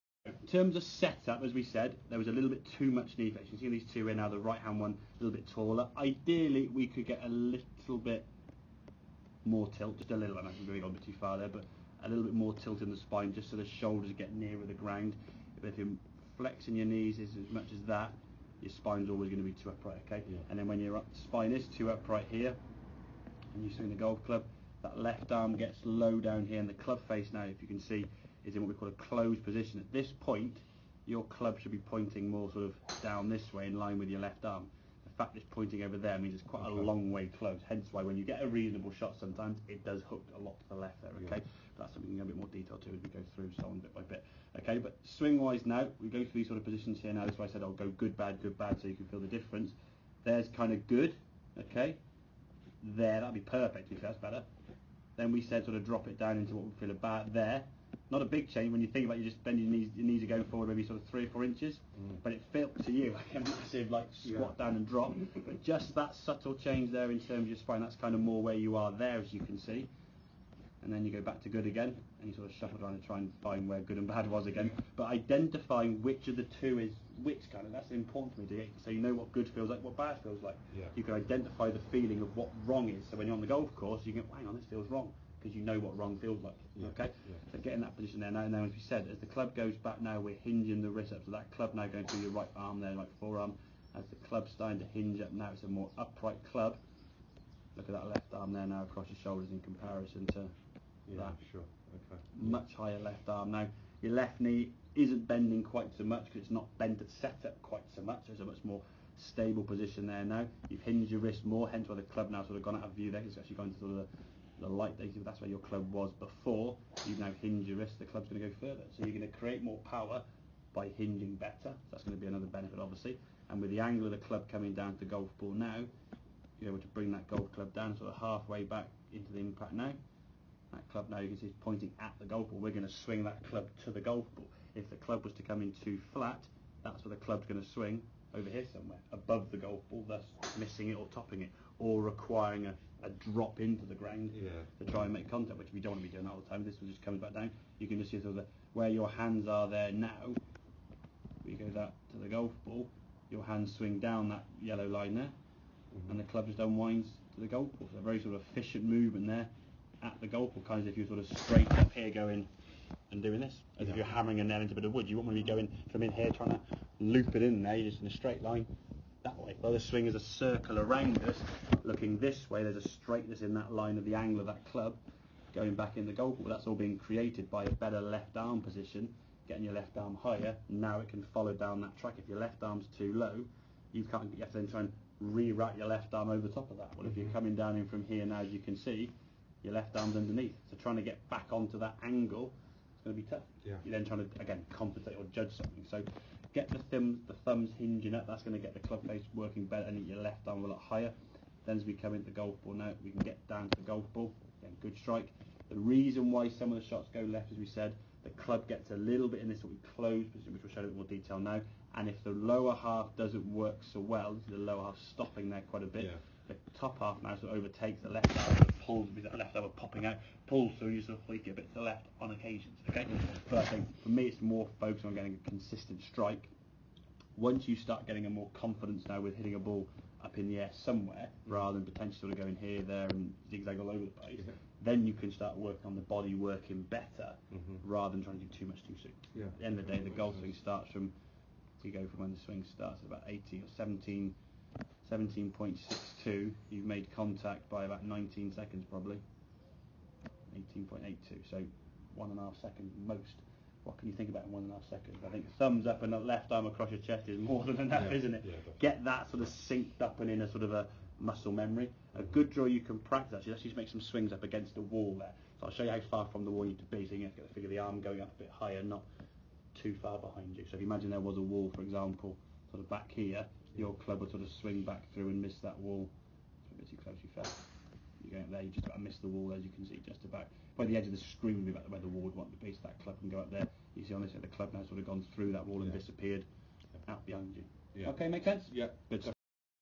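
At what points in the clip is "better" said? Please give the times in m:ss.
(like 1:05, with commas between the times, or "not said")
0:54, 2:01, 2:57, 3:19, 3:56.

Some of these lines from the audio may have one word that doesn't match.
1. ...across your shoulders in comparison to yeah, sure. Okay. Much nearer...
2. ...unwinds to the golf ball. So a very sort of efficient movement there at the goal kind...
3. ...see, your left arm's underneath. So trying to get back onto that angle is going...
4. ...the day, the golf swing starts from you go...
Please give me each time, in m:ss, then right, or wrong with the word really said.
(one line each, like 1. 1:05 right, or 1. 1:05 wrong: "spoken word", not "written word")
1. 1:38 wrong: "higher", not "nearer"
2. 2:36 right
3. 3:08 right
4. 3:59 right.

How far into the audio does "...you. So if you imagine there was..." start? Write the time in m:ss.
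4:30.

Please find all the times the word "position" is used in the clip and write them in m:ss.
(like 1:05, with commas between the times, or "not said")
0:29, 0:46, 1:27, 1:49, 2:58, 3:30.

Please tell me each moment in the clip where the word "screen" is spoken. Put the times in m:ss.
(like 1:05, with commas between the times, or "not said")
4:41.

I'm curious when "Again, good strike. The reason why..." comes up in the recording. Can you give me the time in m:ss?
3:24.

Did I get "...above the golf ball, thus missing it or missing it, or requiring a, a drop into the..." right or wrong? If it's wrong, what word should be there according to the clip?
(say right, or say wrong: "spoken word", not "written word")
wrong: "topping", not "missing".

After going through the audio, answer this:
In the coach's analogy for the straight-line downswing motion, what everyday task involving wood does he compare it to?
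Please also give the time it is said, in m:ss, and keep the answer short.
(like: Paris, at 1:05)
hammering a nail, at 2:44.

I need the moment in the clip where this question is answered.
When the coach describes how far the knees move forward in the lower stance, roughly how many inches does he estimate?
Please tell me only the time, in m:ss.
1:01.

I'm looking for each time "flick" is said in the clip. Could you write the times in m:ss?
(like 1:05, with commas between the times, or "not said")
3:41.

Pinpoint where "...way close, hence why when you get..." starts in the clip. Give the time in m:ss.
0:37.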